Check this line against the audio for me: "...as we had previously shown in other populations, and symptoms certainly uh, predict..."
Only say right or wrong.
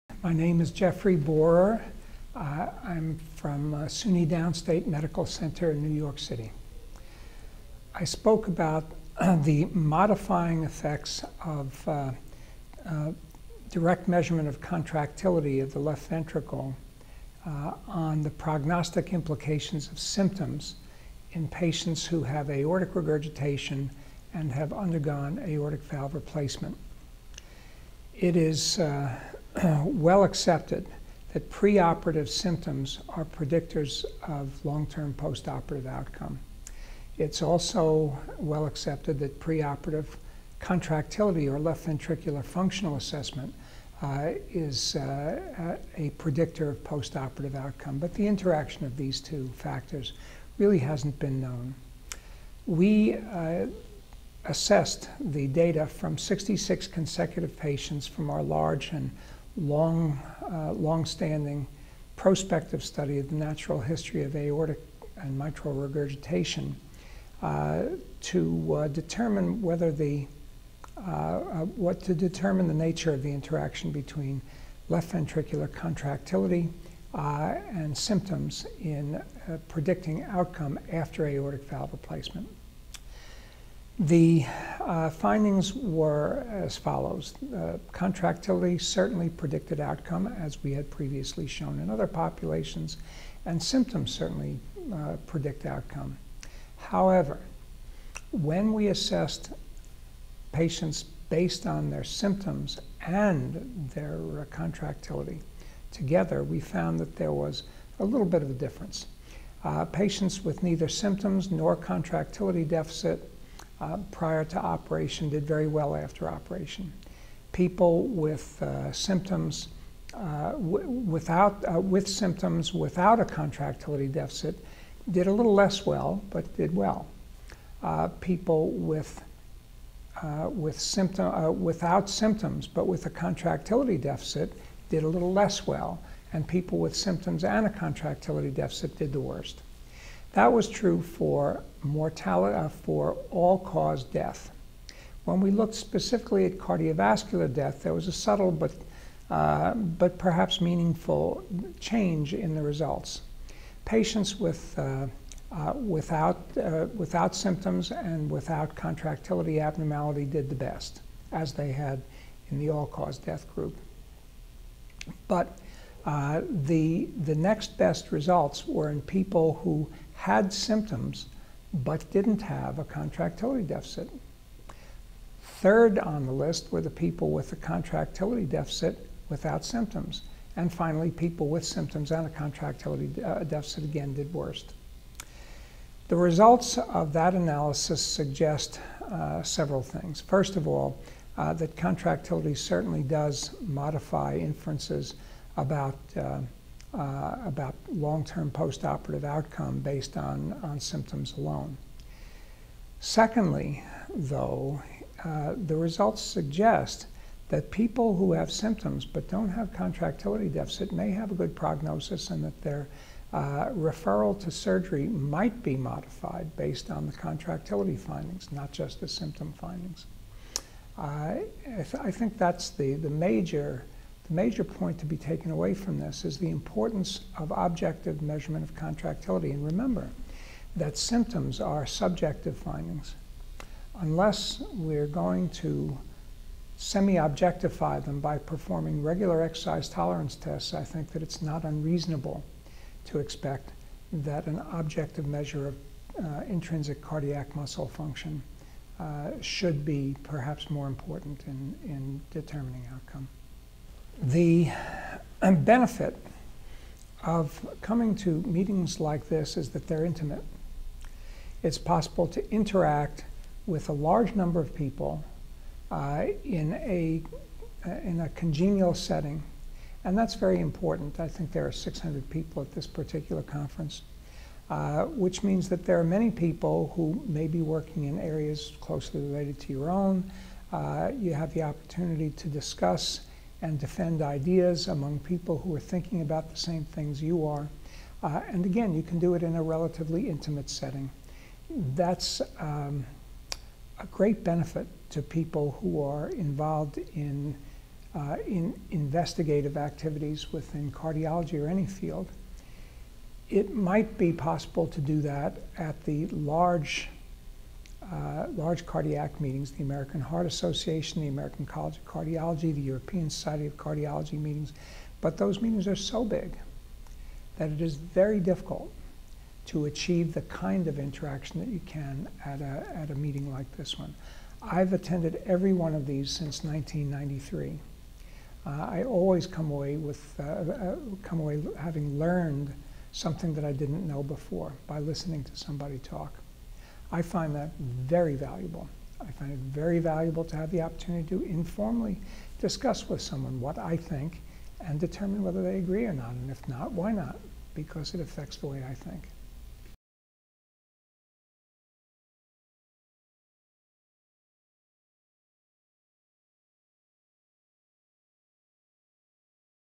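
right.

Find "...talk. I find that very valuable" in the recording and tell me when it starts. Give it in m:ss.
5:35.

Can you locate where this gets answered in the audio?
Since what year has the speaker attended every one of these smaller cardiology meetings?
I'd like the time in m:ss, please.
5:26.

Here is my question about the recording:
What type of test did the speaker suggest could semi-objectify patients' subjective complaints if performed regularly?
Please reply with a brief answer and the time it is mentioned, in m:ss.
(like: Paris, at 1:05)
exercise tolerance tests, at 3:59.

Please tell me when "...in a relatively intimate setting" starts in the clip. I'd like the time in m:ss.
4:49.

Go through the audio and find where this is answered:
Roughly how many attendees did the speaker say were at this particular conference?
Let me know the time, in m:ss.
4:31.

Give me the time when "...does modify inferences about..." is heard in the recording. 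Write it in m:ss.
3:13.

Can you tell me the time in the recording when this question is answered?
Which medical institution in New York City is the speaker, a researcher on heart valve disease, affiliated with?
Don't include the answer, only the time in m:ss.
0:03.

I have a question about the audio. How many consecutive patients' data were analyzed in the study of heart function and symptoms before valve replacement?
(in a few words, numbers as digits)
66.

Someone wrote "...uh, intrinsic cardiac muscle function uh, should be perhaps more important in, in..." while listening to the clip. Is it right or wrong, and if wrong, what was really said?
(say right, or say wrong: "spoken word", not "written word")
right.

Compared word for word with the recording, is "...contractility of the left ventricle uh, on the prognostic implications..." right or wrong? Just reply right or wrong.
right.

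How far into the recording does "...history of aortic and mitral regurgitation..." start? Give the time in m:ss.
1:03.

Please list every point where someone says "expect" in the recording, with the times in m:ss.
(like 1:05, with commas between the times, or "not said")
4:03.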